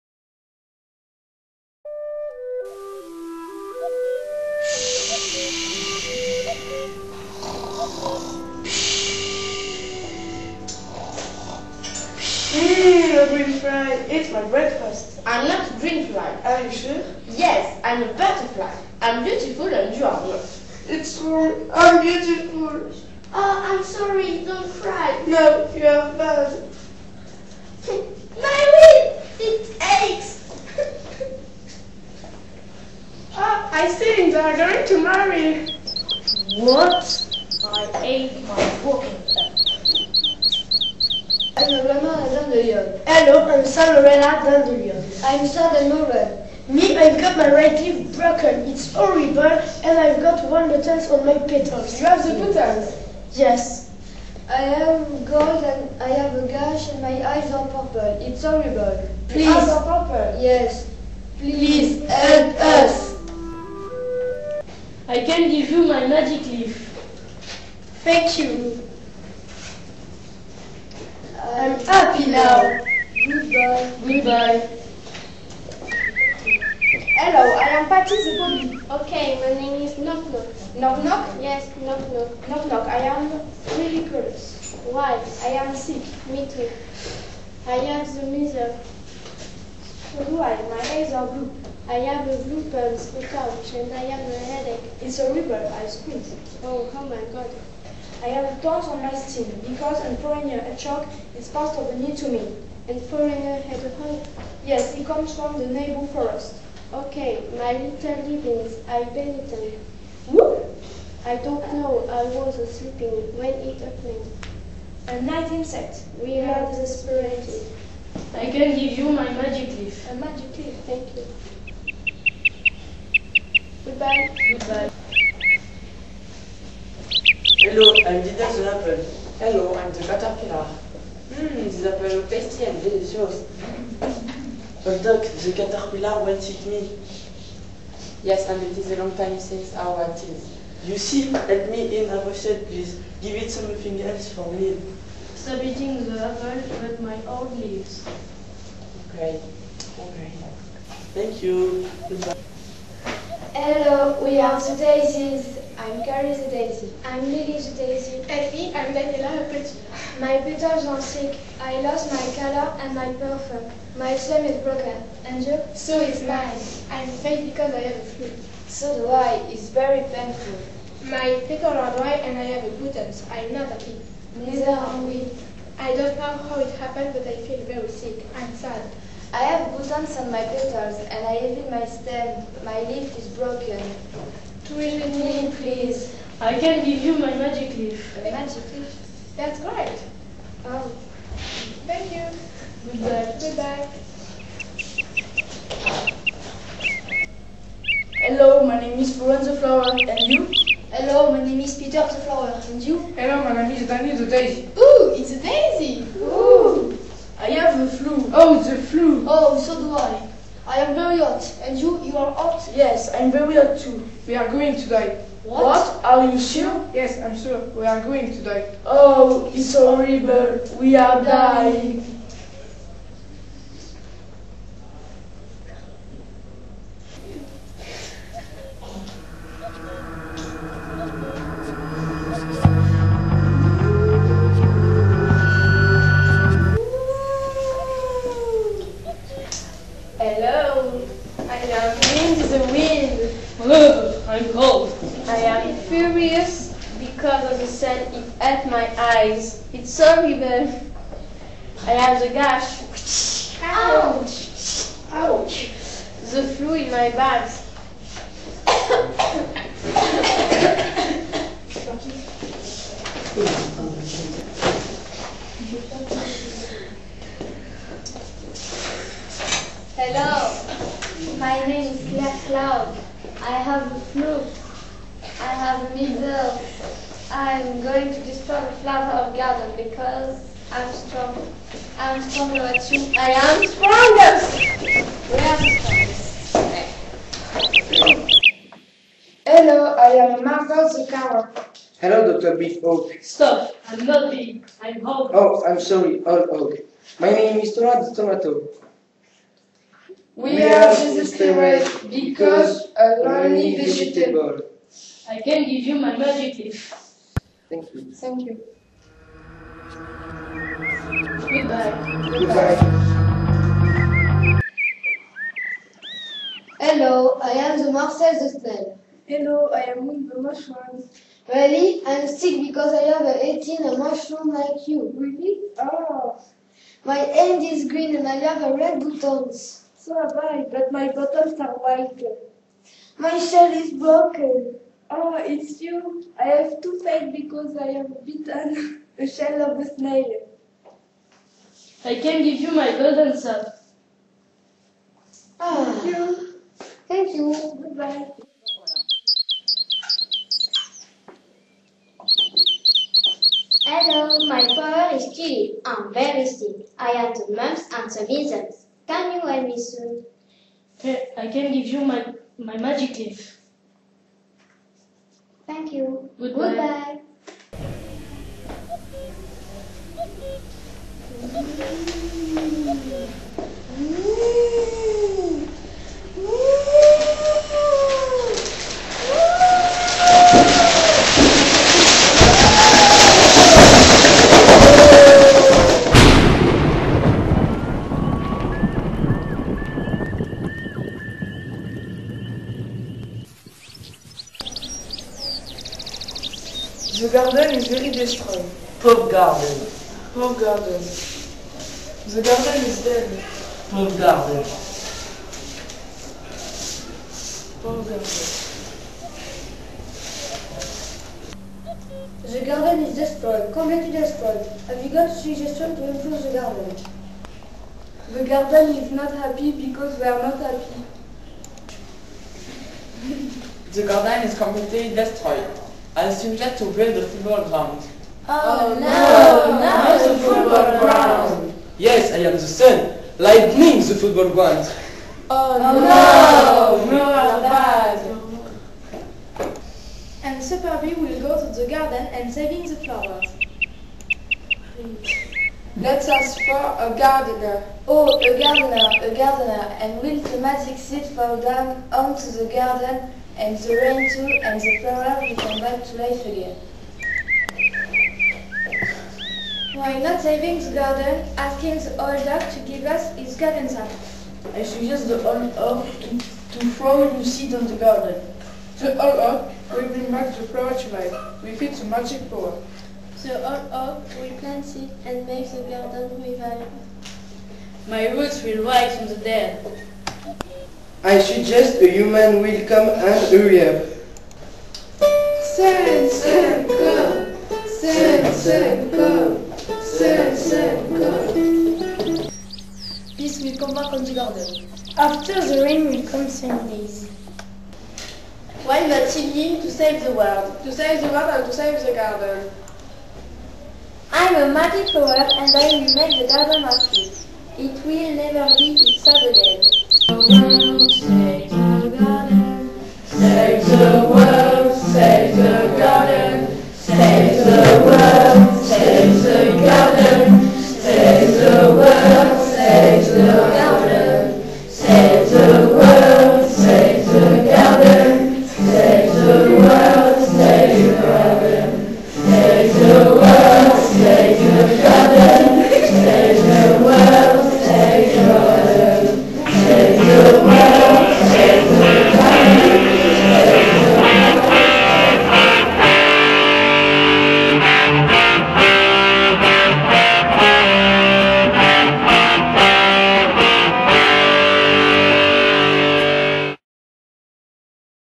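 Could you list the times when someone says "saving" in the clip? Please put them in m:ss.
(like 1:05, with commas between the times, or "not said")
7:22, 7:40.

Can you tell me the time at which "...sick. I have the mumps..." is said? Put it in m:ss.
5:56.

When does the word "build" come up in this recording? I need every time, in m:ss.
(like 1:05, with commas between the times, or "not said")
7:06.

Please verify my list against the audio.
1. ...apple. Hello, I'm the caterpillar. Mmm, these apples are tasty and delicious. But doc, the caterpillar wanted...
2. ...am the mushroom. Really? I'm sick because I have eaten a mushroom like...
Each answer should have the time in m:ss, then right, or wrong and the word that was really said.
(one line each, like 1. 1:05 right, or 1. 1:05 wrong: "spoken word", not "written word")
1. 2:08 right
2. 5:19 right.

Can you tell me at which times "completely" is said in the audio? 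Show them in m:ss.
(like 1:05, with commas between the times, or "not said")
6:53, 7:04.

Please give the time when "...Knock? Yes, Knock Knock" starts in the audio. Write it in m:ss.
1:21.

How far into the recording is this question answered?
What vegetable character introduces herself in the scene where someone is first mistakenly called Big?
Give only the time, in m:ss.
4:57.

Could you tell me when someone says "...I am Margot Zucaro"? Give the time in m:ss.
4:49.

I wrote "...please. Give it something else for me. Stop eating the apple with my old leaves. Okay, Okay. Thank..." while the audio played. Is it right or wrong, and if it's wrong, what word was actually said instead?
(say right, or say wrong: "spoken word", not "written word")
right.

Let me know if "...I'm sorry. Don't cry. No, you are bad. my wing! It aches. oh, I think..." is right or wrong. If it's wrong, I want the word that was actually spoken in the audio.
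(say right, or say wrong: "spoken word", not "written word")
right.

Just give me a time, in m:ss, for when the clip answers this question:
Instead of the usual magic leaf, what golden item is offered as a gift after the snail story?
5:42.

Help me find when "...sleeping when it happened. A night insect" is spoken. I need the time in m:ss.
1:52.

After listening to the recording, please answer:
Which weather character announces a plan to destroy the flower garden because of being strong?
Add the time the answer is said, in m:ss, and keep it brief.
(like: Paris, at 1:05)
Claire Cloud, at 4:32.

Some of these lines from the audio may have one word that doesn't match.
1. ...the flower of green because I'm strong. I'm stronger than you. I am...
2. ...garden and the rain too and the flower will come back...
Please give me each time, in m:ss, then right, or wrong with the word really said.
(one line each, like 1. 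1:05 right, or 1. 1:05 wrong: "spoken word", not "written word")
1. 4:38 wrong: "garden", not "green"
2. 7:32 right.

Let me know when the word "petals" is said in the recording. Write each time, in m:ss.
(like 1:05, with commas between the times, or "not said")
0:51, 2:40, 2:51, 3:00.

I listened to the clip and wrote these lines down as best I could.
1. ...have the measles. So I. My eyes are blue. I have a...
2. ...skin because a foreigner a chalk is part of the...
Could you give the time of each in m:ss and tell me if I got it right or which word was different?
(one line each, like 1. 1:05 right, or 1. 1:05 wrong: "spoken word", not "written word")
1. 1:27 right
2. 1:39 right.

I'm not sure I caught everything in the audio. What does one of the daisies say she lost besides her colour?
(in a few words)
Perfume.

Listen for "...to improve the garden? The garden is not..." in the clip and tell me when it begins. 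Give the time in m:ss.
6:55.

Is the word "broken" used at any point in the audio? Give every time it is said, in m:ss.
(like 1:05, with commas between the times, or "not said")
0:48, 2:44, 3:03, 5:33.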